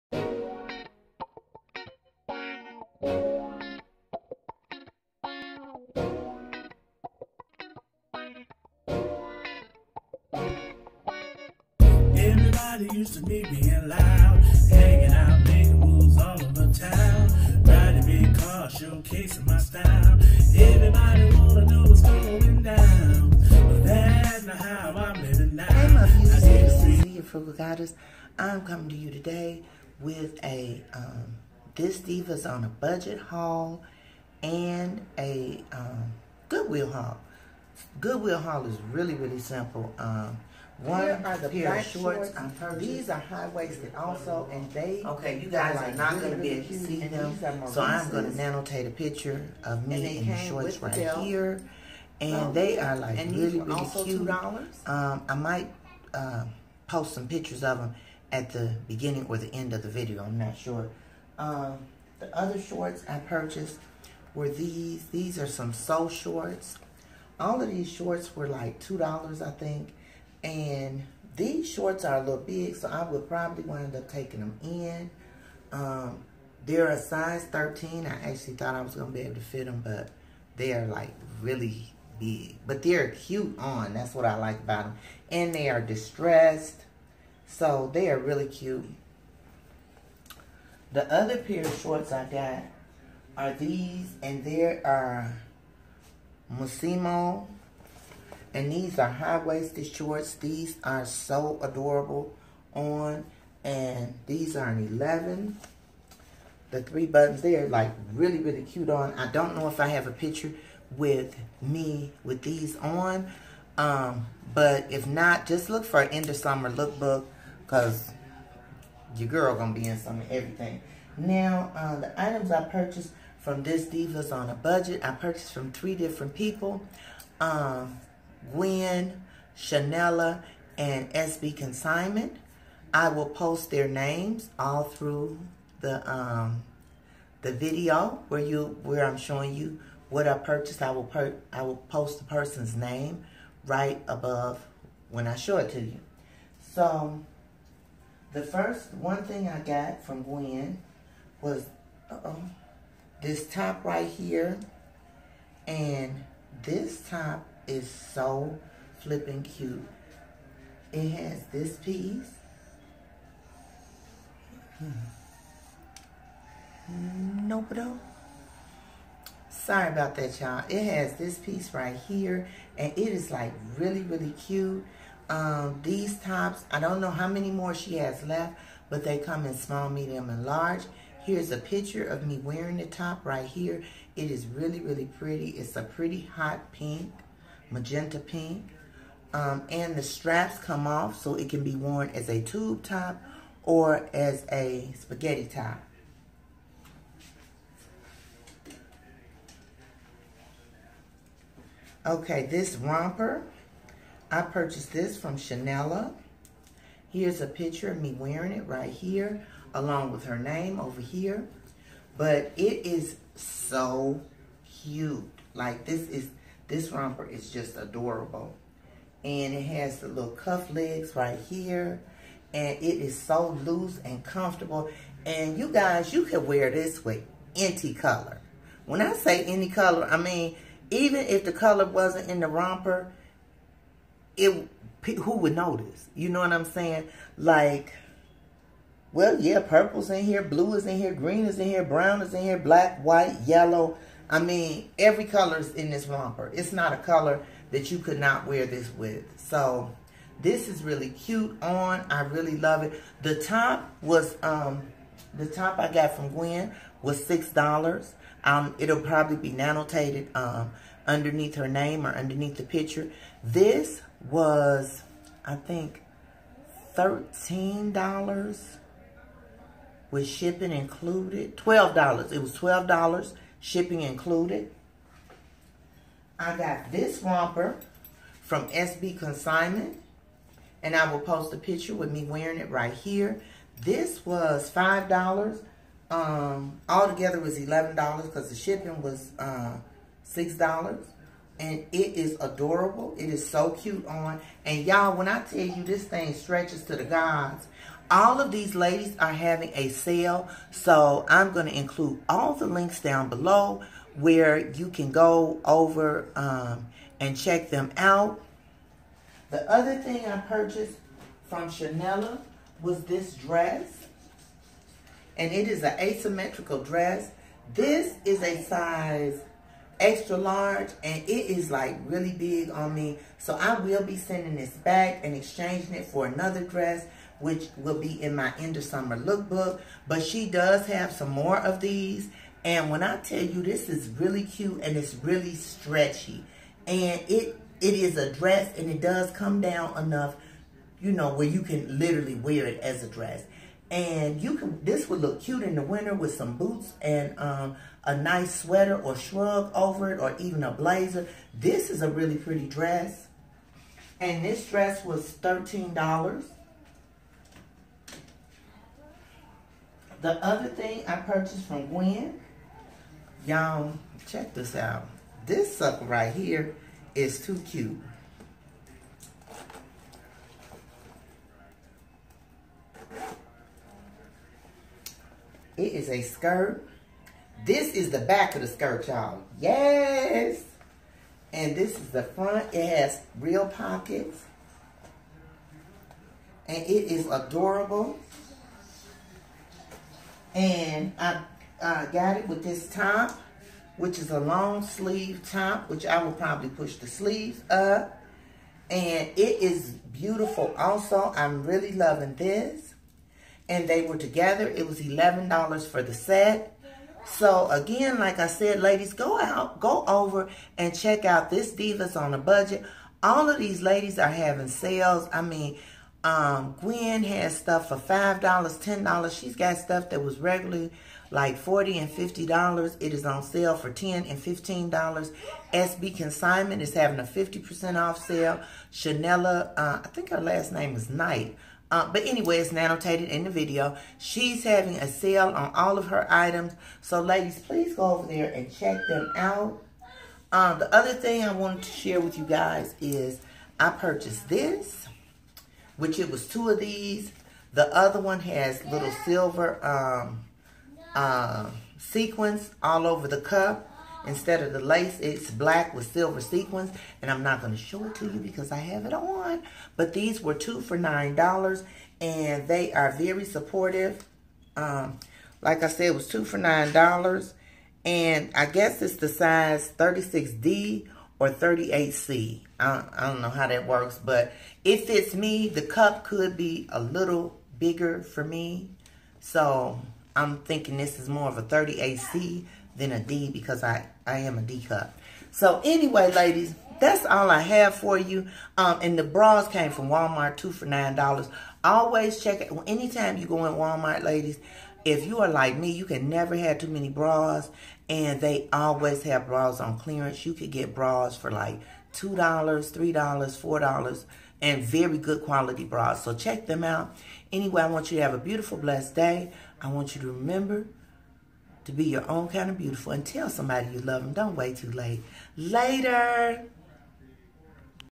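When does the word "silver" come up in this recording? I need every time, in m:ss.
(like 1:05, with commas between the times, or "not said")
7:29, 7:36.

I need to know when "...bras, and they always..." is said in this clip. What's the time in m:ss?
8:17.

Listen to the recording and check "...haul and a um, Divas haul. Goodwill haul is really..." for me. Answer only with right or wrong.
wrong.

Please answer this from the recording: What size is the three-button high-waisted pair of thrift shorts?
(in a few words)
11.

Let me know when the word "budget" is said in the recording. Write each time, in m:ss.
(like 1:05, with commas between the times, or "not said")
0:32, 2:04, 6:52.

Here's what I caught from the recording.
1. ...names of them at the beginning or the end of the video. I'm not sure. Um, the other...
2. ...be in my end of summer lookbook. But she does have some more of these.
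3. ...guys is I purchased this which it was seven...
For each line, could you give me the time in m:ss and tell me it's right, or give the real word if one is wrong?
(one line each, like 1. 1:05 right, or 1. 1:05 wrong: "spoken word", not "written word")
1. 0:57 wrong: "pictures", not "names"
2. 5:27 right
3. 7:22 wrong: "two", not "seven".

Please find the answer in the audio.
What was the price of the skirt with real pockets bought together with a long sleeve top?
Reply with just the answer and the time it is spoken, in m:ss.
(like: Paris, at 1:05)
$11, at 6:44.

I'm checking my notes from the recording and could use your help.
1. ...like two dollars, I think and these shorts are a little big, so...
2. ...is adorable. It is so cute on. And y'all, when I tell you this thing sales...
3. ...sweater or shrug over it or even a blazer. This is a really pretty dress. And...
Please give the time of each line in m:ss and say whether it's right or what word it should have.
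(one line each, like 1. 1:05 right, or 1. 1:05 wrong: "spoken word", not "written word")
1. 1:08 right
2. 4:52 wrong: "stretches", not "sales"
3. 5:48 right.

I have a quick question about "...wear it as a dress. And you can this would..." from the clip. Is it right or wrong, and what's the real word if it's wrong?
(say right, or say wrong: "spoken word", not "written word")
right.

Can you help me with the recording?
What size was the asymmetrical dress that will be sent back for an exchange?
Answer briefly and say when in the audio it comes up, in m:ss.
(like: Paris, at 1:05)
extra large, at 5:20.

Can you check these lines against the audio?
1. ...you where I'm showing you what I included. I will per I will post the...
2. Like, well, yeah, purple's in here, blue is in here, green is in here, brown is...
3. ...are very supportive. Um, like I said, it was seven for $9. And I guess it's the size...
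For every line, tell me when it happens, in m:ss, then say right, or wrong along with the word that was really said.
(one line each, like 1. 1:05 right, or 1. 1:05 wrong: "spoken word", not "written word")
1. 2:18 wrong: "purchased", not "included"
2. 3:57 right
3. 7:42 wrong: "two", not "seven".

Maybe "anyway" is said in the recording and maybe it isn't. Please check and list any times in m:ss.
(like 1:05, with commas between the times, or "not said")
7:12, 8:05, 8:27.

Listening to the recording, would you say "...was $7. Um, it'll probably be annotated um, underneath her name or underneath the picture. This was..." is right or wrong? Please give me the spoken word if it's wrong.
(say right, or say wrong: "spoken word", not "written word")
wrong: "6", not "7".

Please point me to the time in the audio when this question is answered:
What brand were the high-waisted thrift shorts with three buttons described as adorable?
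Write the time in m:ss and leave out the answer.
1:36.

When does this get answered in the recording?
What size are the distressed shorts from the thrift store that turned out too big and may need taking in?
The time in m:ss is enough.
1:16.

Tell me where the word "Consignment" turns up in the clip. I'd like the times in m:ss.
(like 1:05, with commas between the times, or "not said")
2:11, 4:39, 7:06.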